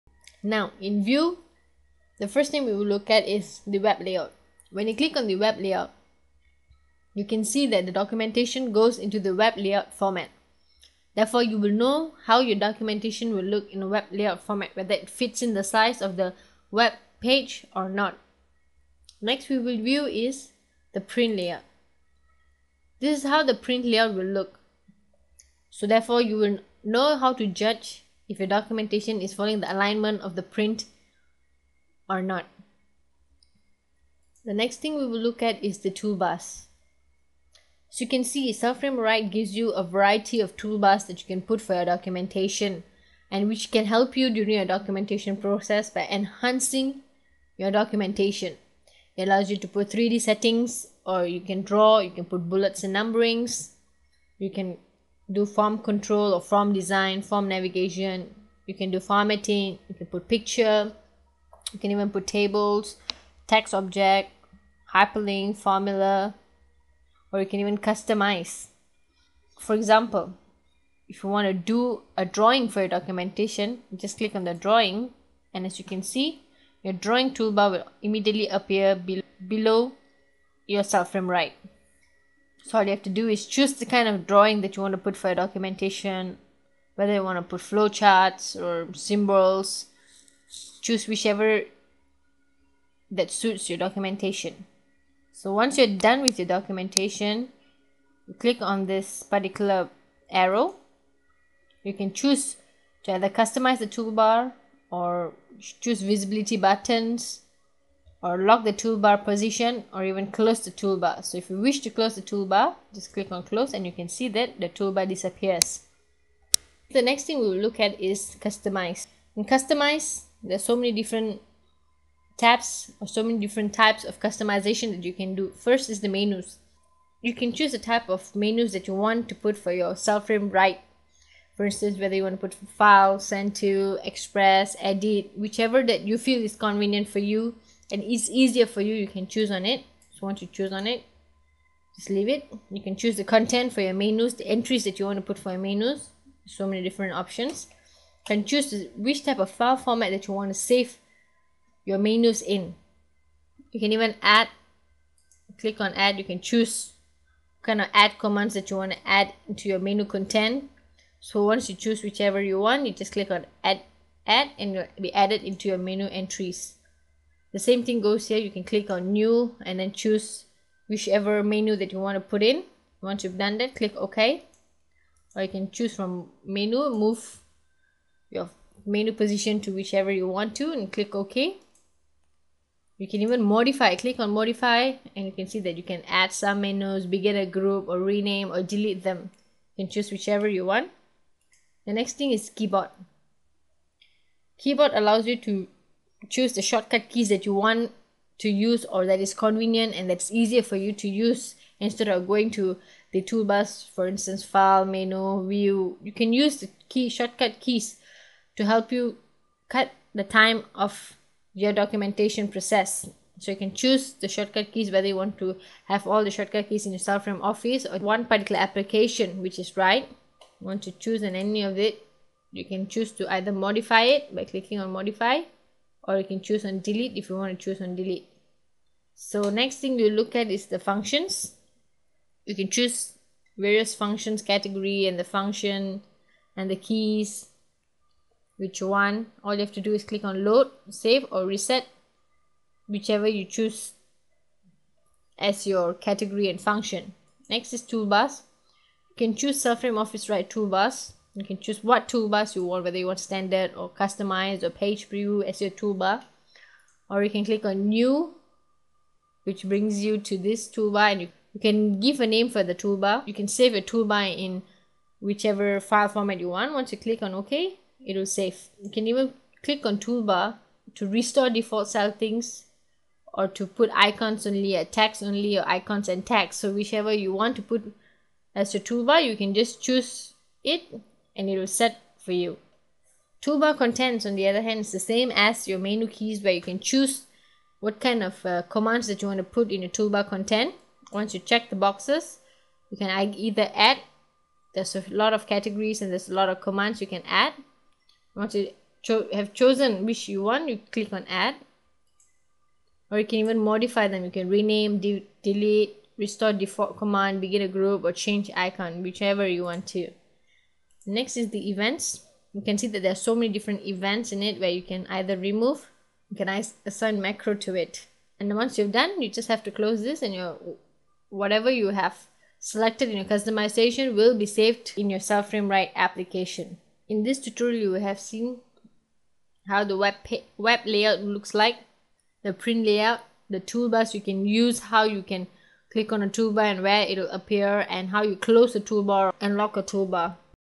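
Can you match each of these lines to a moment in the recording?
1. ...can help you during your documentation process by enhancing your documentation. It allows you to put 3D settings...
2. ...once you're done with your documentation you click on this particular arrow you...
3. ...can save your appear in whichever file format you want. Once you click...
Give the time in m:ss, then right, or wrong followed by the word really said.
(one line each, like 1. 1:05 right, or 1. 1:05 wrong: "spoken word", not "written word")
1. 0:43 right
2. 1:35 right
3. 4:23 wrong: "toolbar", not "appear".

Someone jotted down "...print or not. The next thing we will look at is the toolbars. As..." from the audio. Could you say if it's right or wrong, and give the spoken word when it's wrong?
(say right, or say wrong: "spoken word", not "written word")
right.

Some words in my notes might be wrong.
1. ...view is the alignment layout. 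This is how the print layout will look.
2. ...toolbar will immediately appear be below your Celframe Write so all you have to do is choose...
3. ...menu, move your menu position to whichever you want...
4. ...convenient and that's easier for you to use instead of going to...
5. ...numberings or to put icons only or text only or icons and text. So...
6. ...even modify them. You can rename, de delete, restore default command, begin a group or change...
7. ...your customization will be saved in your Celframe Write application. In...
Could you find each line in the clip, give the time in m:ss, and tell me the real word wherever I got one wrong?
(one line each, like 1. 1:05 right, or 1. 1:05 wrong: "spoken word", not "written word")
1. 0:19 wrong: "print", not "alignment"
2. 1:17 right
3. 2:56 right
4. 3:19 right
5. 4:31 wrong: "settings", not "numberings"
6. 5:03 right
7. 5:23 right.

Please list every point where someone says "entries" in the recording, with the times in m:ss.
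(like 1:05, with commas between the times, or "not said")
2:24, 2:46.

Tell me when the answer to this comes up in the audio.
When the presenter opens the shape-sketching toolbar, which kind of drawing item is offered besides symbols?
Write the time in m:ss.
1:27.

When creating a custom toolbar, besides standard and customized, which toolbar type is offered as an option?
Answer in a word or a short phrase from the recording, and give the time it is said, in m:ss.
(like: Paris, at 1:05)
Page preview, at 4:14.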